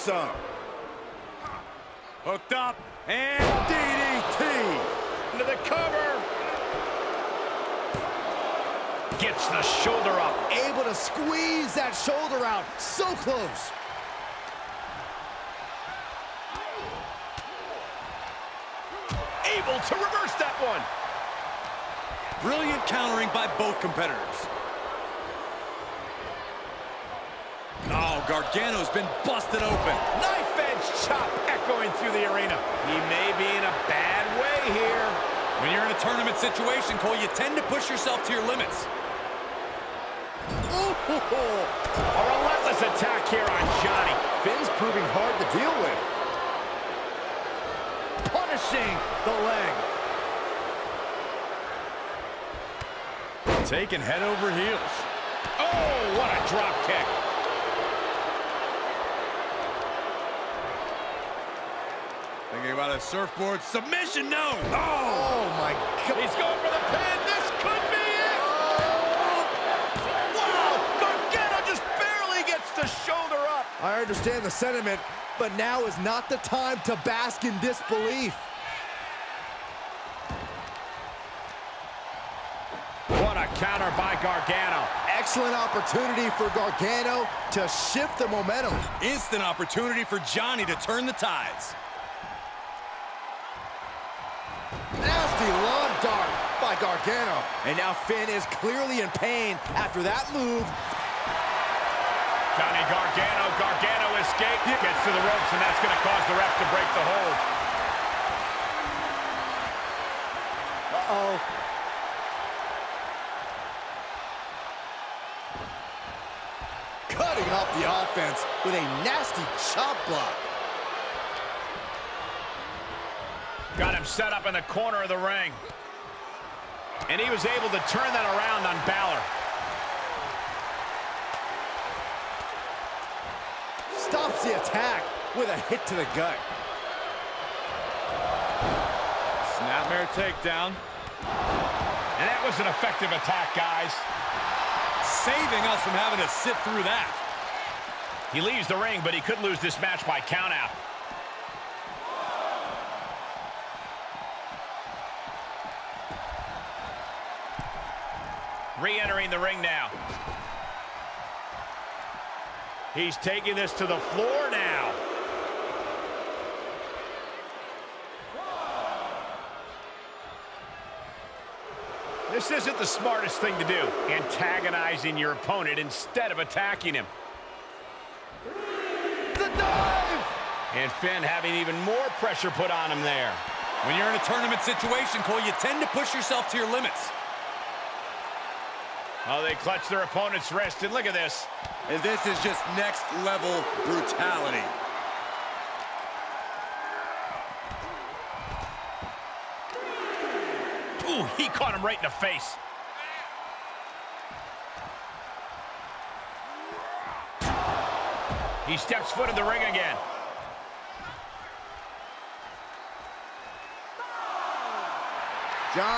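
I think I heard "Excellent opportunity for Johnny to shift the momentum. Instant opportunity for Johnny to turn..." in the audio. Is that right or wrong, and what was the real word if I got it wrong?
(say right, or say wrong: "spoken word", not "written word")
wrong: "Gargano", not "Johnny".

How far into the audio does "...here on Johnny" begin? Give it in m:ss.
0:43.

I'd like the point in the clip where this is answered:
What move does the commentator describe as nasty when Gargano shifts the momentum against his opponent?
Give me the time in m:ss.
1:35.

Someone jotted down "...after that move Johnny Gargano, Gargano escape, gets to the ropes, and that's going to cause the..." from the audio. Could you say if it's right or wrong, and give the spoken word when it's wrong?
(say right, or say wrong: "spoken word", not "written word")
right.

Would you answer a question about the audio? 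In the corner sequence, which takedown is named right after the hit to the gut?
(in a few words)
Snapmare.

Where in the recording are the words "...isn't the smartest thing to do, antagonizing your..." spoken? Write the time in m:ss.
2:52.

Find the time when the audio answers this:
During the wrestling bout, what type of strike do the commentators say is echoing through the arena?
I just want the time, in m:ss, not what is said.
0:30.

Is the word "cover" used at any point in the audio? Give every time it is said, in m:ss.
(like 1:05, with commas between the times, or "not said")
0:05.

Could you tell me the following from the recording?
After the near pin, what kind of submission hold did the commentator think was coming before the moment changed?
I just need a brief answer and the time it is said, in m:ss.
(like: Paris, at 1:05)
Surfboard, at 1:02.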